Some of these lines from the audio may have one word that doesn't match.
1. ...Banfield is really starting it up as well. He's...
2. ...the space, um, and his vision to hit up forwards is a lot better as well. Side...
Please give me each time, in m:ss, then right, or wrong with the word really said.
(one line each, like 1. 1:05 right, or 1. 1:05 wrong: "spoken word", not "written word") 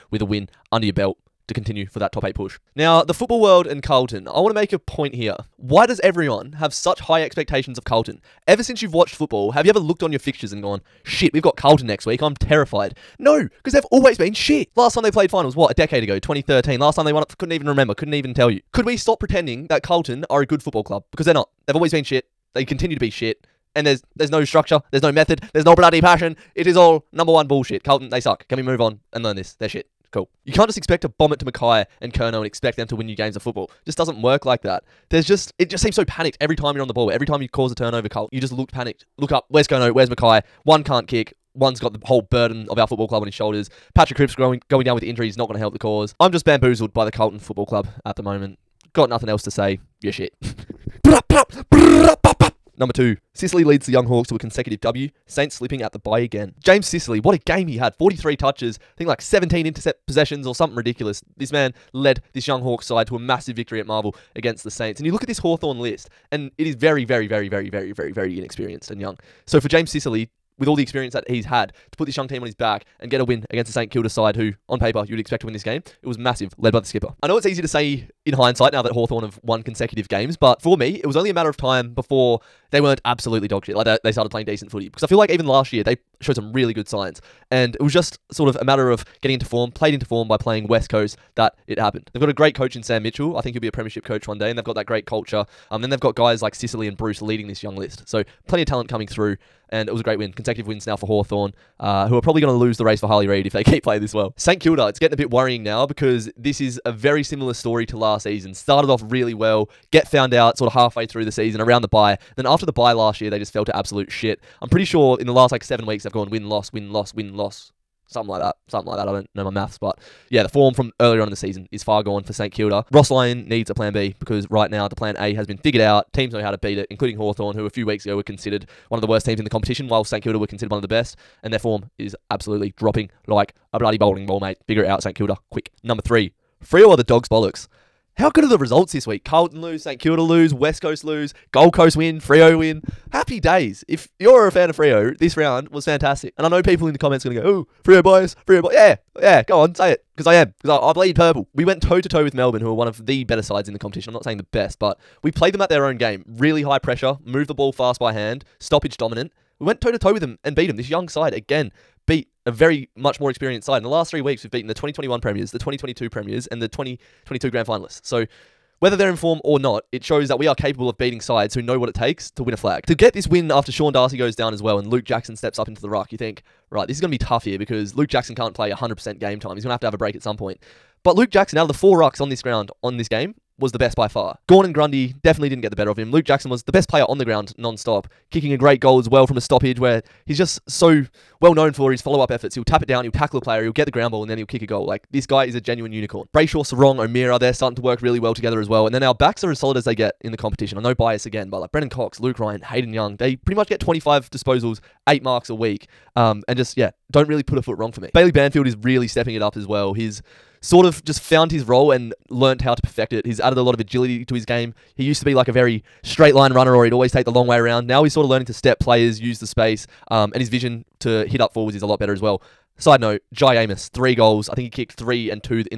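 1. 3:28 wrong: "stepping", not "starting"
2. 3:39 right.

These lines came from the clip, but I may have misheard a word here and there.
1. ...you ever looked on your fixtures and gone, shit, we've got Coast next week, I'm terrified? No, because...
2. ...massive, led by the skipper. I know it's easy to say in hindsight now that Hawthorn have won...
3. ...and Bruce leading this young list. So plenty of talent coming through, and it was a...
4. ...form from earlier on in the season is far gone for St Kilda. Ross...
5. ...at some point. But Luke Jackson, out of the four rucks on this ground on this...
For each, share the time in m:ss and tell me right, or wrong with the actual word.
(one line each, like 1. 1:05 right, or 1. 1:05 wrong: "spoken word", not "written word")
1. 0:09 wrong: "Carlton", not "Coast"
2. 1:16 right
3. 1:36 right
4. 2:00 right
5. 3:00 right.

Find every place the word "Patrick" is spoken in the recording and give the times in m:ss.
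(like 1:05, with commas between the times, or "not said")
0:43.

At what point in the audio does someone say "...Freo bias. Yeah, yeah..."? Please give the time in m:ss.
2:28.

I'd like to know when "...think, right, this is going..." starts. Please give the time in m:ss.
2:56.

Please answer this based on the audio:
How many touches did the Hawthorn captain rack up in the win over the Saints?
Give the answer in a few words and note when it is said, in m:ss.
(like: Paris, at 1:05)
43, at 0:57.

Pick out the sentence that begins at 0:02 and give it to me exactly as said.
Now, the football world and Carlton, I want to make a point here.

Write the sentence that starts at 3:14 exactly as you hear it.
Like, this guy is a genuine unicorn.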